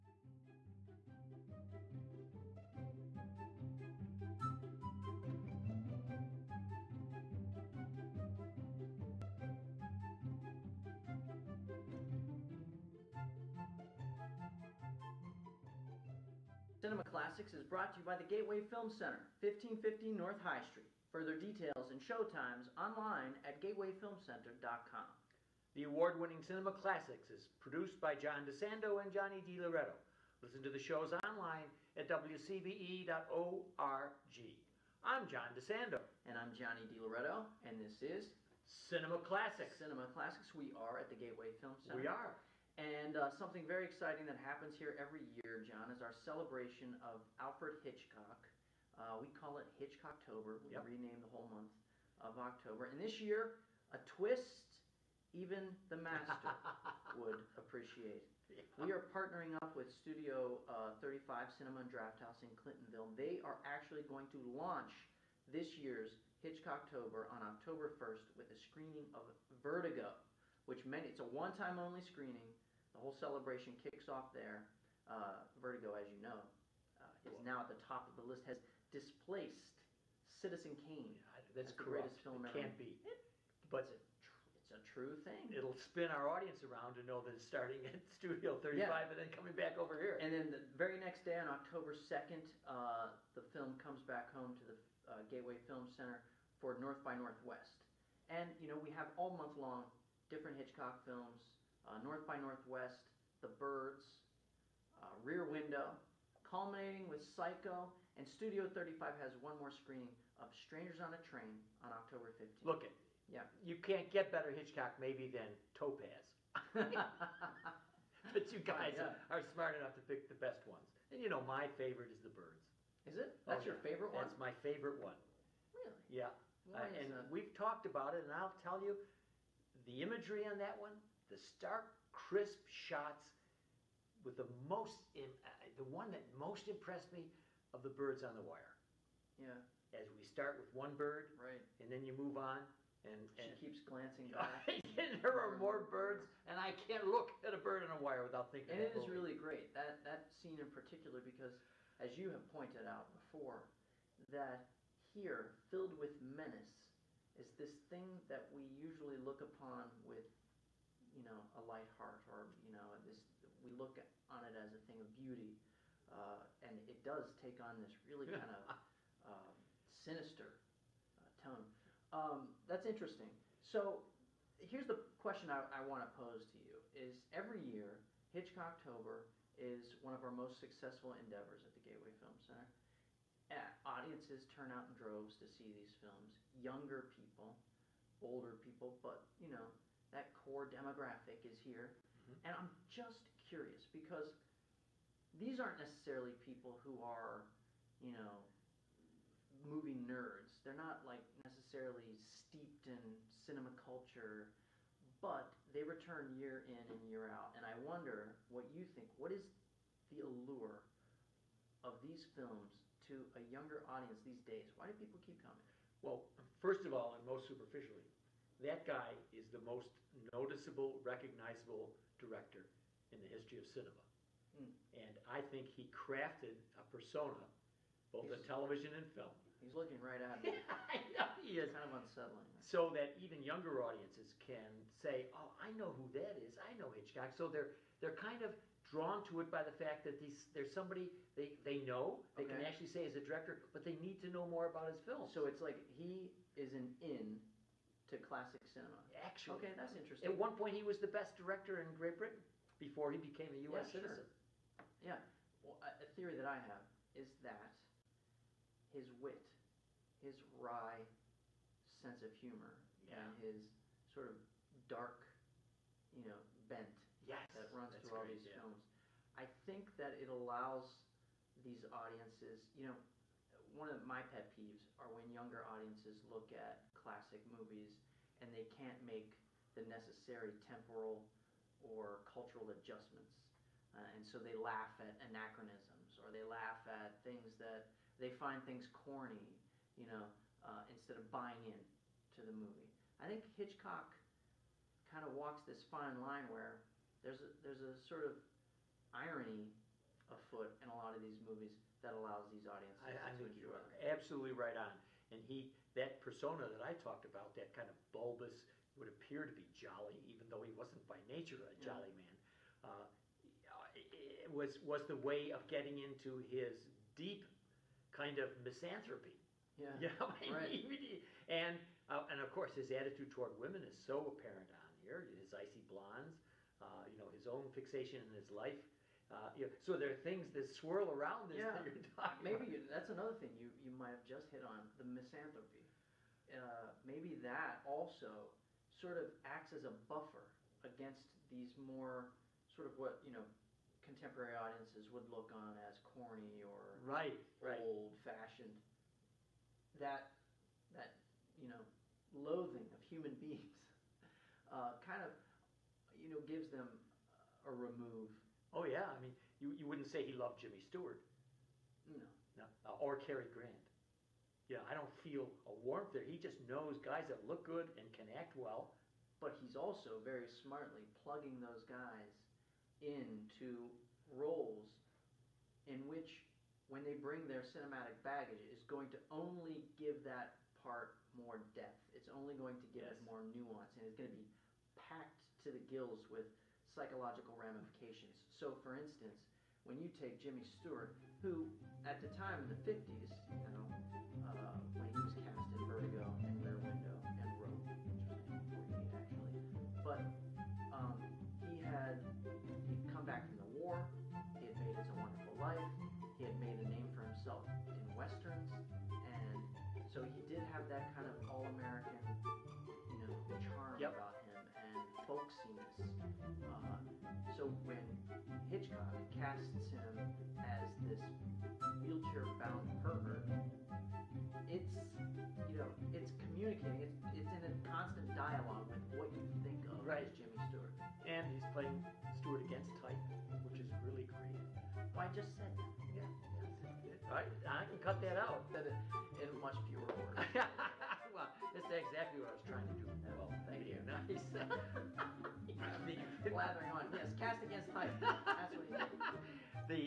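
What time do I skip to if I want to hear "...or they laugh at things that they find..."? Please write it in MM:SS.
04:46.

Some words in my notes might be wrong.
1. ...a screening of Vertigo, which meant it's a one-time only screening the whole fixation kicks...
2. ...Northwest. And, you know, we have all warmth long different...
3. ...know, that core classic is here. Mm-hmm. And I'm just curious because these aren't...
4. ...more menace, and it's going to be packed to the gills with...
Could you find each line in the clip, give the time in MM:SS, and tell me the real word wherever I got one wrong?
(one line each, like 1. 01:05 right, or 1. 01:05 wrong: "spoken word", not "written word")
1. 01:08 wrong: "celebration", not "fixation"
2. 01:37 wrong: "month", not "warmth"
3. 03:09 wrong: "demographic", not "classic"
4. 06:23 wrong: "nuance", not "menace".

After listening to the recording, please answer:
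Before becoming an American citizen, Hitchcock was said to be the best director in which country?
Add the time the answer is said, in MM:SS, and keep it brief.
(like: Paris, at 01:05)
Great Britain, at 04:11.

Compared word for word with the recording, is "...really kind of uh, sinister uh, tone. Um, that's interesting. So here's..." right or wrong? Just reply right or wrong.
right.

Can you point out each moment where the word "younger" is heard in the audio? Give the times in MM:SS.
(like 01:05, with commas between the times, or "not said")
03:06, 03:33, 03:53, 04:35.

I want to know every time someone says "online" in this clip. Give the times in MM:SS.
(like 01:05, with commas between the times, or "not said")
00:22, 00:31.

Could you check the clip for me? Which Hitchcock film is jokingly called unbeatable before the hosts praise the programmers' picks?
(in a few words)
Topaz.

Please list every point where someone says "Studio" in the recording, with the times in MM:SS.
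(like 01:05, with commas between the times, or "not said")
00:59, 01:28, 01:48.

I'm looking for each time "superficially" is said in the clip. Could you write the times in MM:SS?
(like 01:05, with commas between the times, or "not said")
03:37.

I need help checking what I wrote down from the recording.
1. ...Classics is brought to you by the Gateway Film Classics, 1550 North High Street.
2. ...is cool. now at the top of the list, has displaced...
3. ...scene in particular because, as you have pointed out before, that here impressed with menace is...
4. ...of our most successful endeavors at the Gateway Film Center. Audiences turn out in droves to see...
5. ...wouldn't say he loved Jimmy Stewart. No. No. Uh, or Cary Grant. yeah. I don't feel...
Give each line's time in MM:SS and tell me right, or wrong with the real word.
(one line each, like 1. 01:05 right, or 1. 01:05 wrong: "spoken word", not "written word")
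1. 00:17 wrong: "Center", not "Classics"
2. 01:17 right
3. 02:30 wrong: "filled", not "impressed"
4. 03:00 right
5. 05:59 right.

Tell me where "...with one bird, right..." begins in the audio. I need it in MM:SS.
02:20.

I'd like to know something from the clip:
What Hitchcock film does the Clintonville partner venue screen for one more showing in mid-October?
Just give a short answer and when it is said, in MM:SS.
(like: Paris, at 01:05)
Strangers on a Train, at 01:50.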